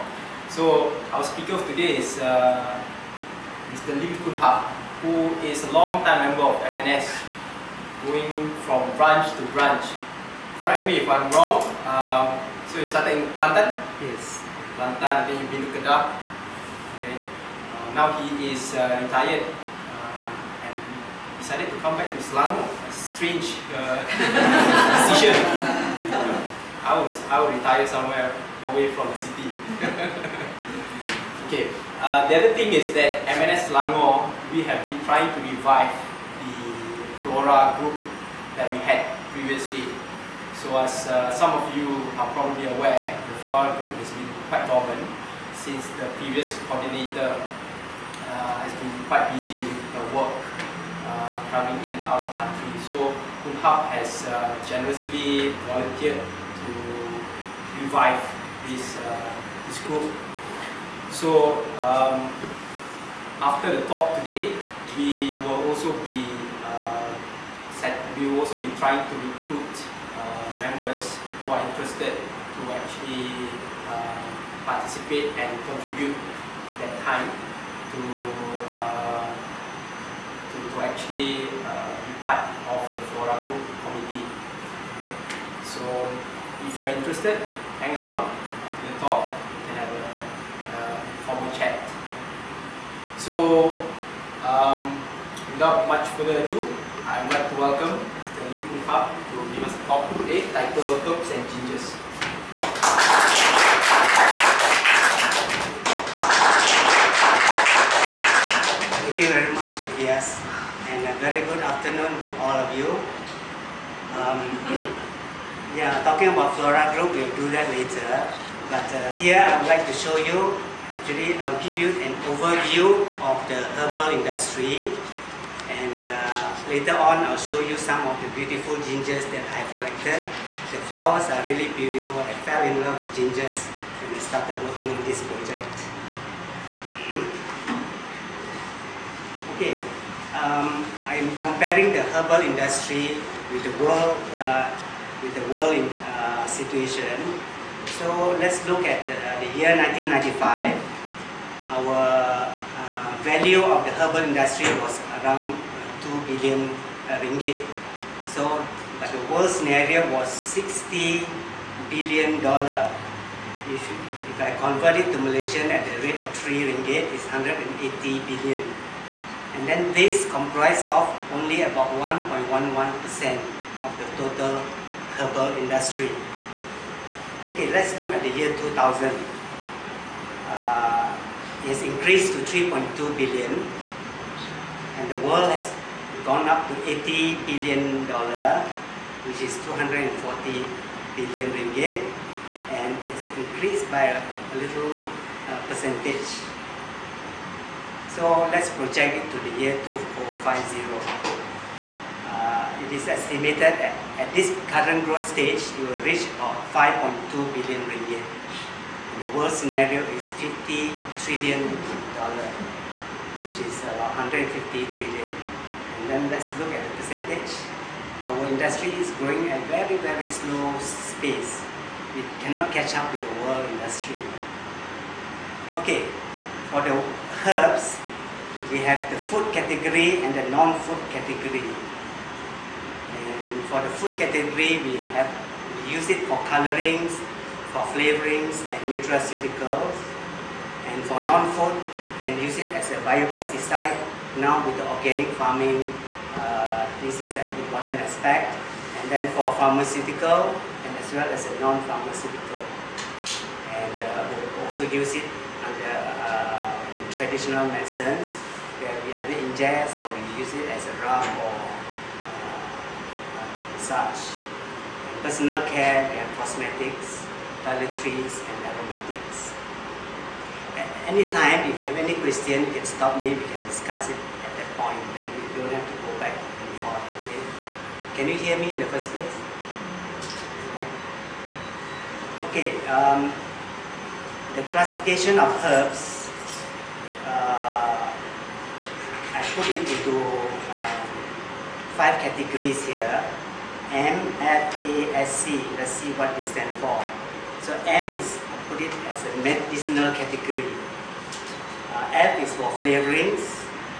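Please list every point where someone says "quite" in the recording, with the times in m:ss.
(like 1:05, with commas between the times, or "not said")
0:44, 0:49.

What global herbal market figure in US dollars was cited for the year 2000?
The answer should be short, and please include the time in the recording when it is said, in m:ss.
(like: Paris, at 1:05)
80 billion dollars, at 3:06.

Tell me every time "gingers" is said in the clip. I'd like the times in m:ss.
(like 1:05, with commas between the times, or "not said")
1:41, 2:08, 2:13.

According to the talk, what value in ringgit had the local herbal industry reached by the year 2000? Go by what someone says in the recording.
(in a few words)
3.2 billion.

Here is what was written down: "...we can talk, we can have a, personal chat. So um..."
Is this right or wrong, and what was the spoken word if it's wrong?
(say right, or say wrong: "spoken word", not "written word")
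wrong: "formal", not "personal".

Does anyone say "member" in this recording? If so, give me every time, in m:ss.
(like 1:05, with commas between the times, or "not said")
0:06, 1:10.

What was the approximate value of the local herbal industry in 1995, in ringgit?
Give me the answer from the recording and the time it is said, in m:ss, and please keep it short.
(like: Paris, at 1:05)
2 billion ringgit, at 2:36.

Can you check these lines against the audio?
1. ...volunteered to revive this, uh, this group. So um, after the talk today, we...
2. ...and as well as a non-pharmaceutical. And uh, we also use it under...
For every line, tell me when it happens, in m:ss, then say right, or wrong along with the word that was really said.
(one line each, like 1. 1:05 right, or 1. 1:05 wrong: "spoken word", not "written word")
1. 0:55 right
2. 4:10 right.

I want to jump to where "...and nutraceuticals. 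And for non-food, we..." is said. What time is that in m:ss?
3:58.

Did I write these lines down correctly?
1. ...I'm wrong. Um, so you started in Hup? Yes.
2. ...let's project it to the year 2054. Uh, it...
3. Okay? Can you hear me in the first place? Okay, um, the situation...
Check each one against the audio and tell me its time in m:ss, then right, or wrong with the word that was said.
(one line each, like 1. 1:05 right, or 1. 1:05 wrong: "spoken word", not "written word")
1. 0:11 wrong: "Kelantan", not "Hup"
2. 3:18 wrong: "2050", not "2054"
3. 4:37 wrong: "classification", not "situation".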